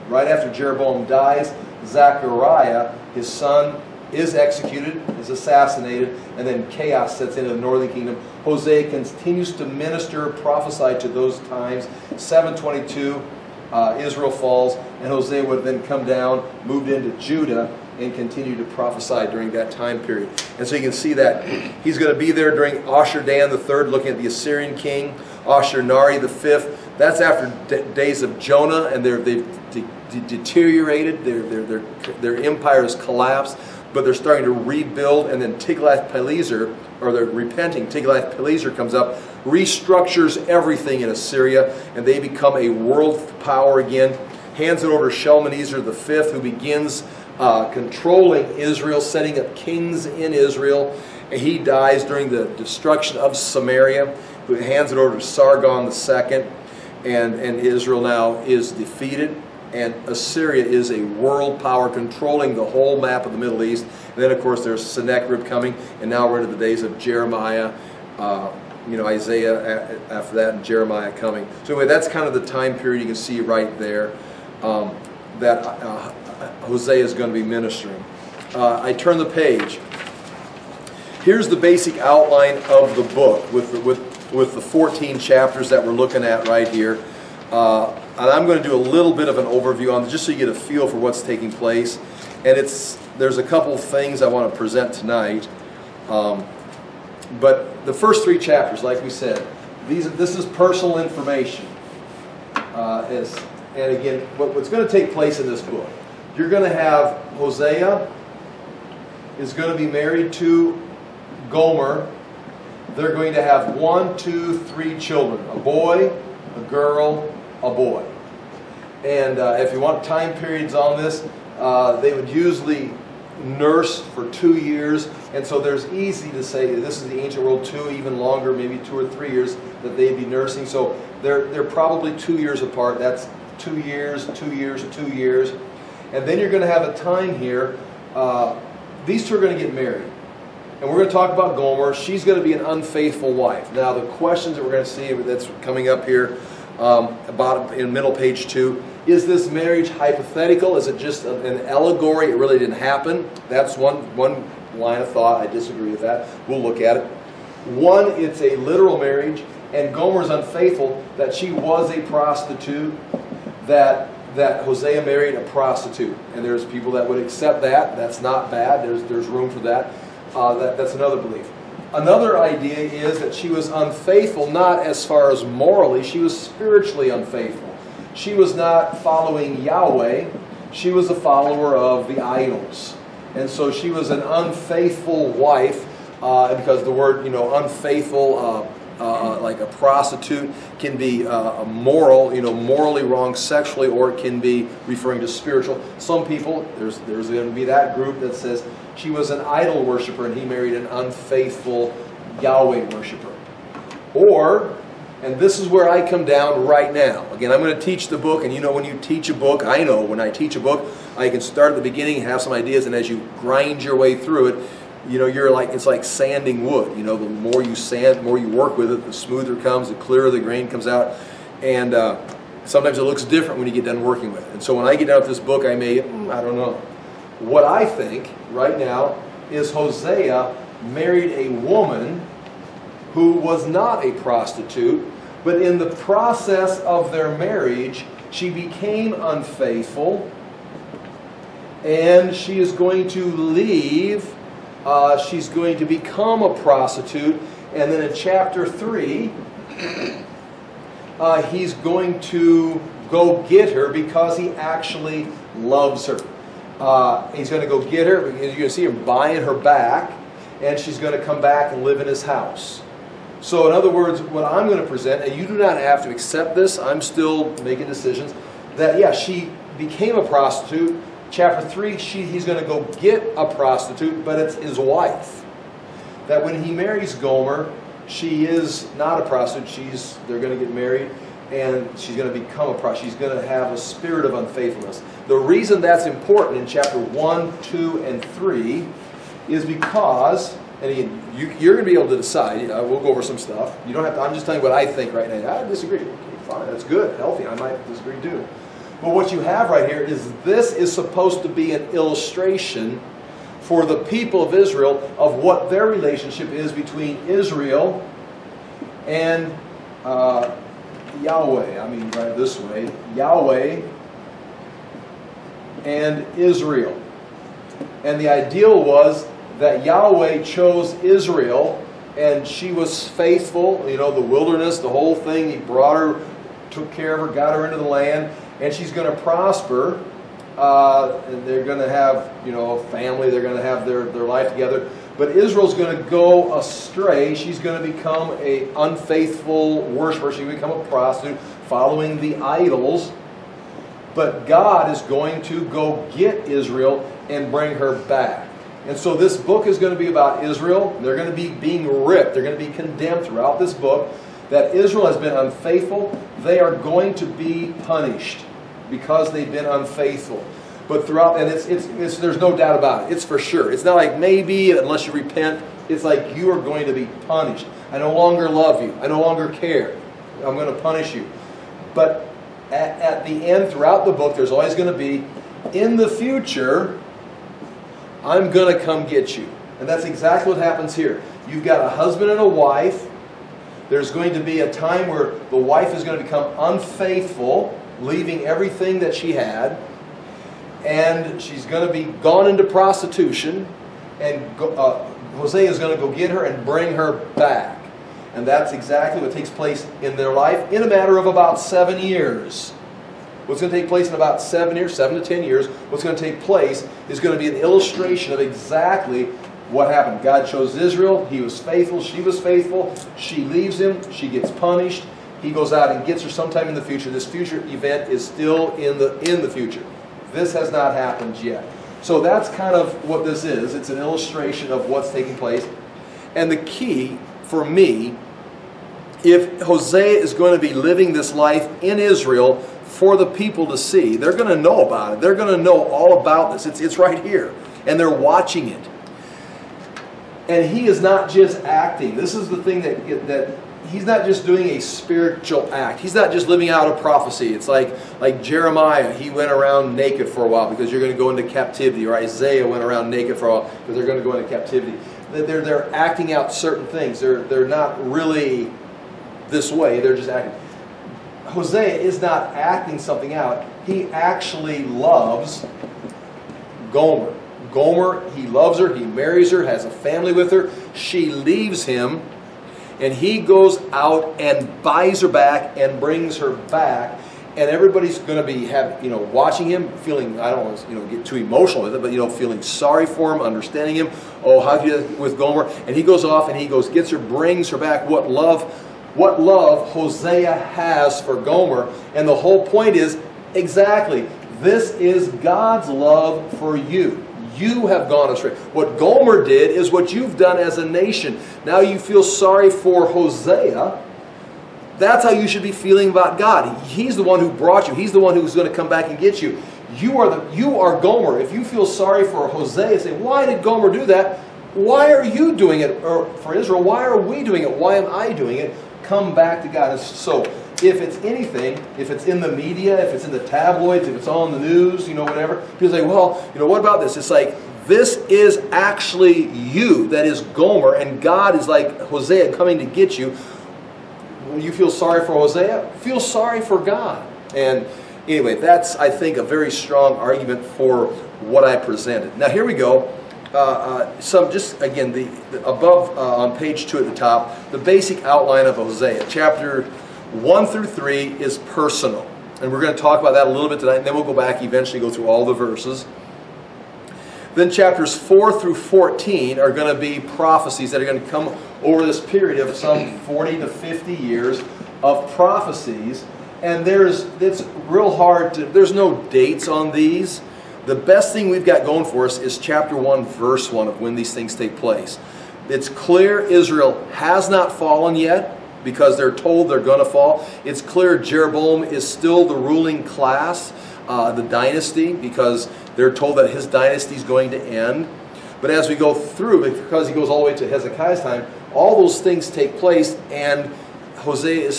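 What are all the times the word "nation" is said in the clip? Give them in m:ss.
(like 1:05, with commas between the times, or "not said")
8:20.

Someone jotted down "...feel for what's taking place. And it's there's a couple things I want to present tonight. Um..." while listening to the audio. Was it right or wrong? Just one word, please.
right.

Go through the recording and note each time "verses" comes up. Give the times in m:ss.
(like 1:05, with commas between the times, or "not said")
9:15, 9:33.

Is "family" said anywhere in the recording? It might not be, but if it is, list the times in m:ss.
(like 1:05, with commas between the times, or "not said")
5:32, 7:49.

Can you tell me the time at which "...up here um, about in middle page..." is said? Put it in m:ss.
2:25.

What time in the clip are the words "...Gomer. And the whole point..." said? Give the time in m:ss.
8:11.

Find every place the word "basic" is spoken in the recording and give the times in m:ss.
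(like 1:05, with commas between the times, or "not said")
1:21, 9:07.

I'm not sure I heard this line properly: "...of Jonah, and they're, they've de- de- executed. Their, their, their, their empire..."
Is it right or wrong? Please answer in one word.
wrong.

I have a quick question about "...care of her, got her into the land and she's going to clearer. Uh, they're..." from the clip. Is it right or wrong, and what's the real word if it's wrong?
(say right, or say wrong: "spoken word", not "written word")
wrong: "prosper", not "clearer".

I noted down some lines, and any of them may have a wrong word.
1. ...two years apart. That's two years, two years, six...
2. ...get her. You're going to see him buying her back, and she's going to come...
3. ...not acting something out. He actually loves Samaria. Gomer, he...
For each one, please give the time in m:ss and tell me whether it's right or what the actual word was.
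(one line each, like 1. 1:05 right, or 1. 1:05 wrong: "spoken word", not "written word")
1. 2:12 wrong: "two", not "six"
2. 4:17 right
3. 7:42 wrong: "Gomer", not "Samaria".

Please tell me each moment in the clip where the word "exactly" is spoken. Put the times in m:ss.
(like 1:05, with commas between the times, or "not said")
6:20, 6:38, 6:48, 8:13.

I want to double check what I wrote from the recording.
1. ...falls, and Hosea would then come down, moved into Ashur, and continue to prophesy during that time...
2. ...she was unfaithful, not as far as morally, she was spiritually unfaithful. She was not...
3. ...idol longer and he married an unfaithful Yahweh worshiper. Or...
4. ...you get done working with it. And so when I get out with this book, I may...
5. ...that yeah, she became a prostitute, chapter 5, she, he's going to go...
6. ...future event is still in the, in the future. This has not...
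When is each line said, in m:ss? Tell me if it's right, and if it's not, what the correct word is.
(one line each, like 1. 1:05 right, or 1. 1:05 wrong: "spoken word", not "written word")
1. 0:14 wrong: "Judah", not "Ashur"
2. 2:53 right
3. 3:19 wrong: "worshiper", not "longer"
4. 3:43 right
5. 4:28 wrong: "3", not "5"
6. 6:57 right.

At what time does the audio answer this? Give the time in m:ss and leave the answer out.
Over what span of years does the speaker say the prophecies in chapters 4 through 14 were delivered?
9:23.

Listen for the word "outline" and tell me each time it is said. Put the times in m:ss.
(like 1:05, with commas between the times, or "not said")
1:21, 9:08.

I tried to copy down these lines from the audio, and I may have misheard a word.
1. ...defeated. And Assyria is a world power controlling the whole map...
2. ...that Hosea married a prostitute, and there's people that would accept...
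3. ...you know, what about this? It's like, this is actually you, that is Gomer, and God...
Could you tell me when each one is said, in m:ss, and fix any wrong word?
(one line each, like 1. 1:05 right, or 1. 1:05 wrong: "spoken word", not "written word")
1. 0:58 right
2. 2:44 right
3. 8:46 right.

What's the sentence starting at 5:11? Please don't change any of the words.
I mean, right this way Yahweh and Israel.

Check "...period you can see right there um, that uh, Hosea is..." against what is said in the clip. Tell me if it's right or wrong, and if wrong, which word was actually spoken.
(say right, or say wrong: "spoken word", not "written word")
right.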